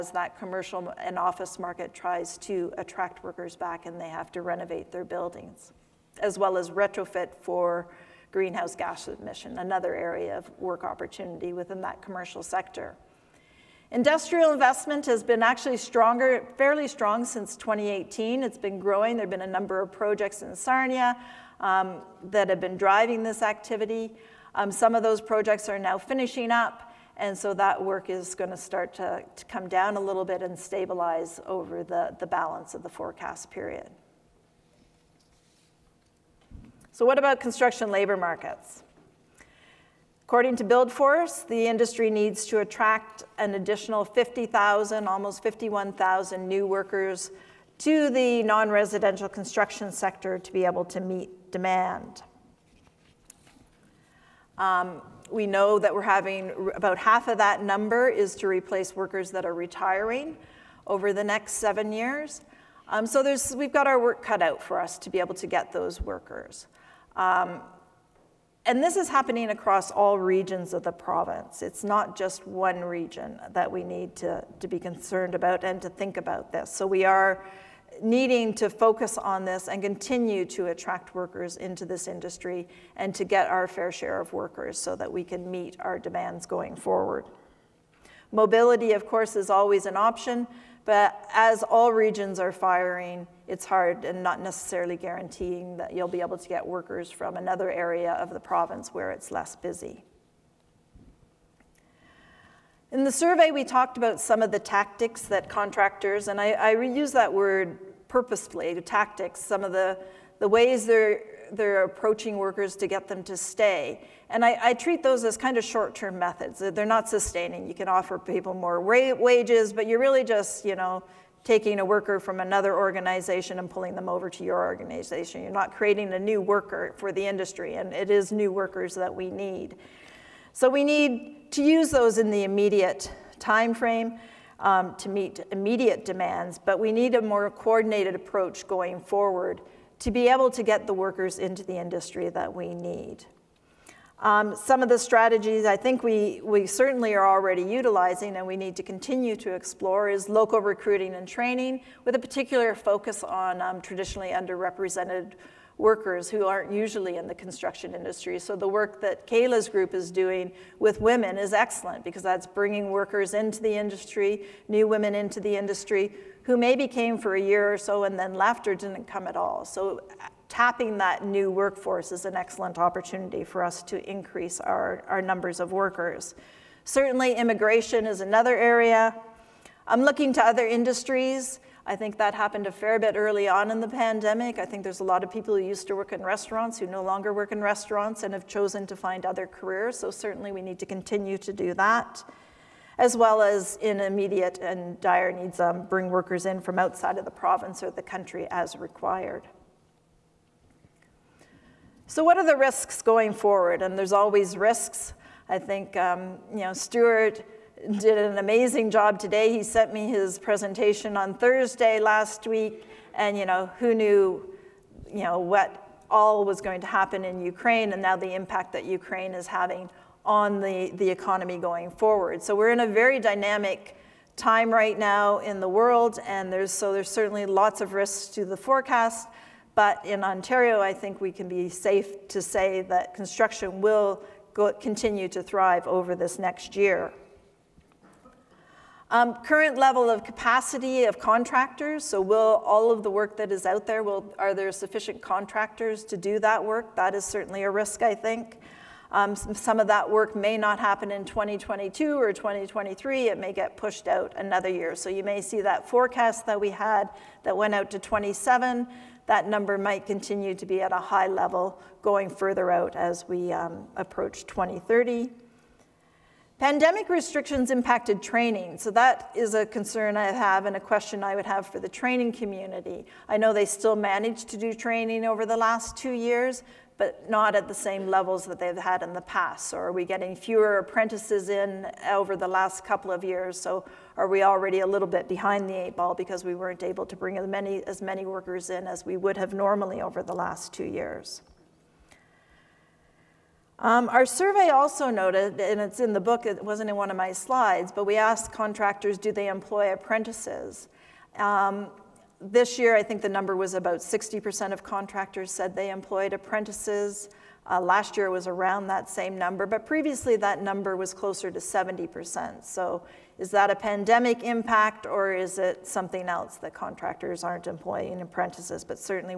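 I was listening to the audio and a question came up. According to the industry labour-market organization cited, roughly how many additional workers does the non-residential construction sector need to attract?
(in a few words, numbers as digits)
almost 51,000.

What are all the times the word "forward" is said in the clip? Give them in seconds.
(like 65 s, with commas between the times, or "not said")
86 s, 138 s, 203 s, 221 s.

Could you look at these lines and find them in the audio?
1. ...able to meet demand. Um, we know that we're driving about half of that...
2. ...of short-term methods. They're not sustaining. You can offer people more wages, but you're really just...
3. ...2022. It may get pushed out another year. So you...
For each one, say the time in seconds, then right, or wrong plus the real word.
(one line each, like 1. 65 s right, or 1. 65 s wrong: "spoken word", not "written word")
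1. 50 s wrong: "having", not "driving"
2. 115 s right
3. 252 s wrong: "2023", not "2022".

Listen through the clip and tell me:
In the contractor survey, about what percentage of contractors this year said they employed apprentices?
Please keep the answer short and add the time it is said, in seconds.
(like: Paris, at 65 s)
60%, at 303 s.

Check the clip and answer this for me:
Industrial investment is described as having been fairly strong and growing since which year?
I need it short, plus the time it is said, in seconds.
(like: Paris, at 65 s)
2018, at 17 s.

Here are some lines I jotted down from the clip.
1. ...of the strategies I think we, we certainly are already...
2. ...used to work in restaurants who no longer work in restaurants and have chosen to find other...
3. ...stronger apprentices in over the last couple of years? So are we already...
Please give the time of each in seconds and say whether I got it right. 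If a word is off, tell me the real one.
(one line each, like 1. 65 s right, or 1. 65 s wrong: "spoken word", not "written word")
1. 144 s right
2. 185 s right
3. 280 s wrong: "fewer", not "stronger".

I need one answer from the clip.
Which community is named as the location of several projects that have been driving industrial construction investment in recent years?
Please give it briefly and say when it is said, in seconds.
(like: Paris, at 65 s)
Sarnia, at 20 s.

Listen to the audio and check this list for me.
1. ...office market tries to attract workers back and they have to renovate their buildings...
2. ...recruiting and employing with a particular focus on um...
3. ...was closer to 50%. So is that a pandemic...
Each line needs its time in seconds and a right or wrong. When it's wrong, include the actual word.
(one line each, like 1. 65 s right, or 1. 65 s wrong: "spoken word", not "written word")
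1. 1 s right
2. 150 s wrong: "training", not "employing"
3. 310 s wrong: "70", not "50".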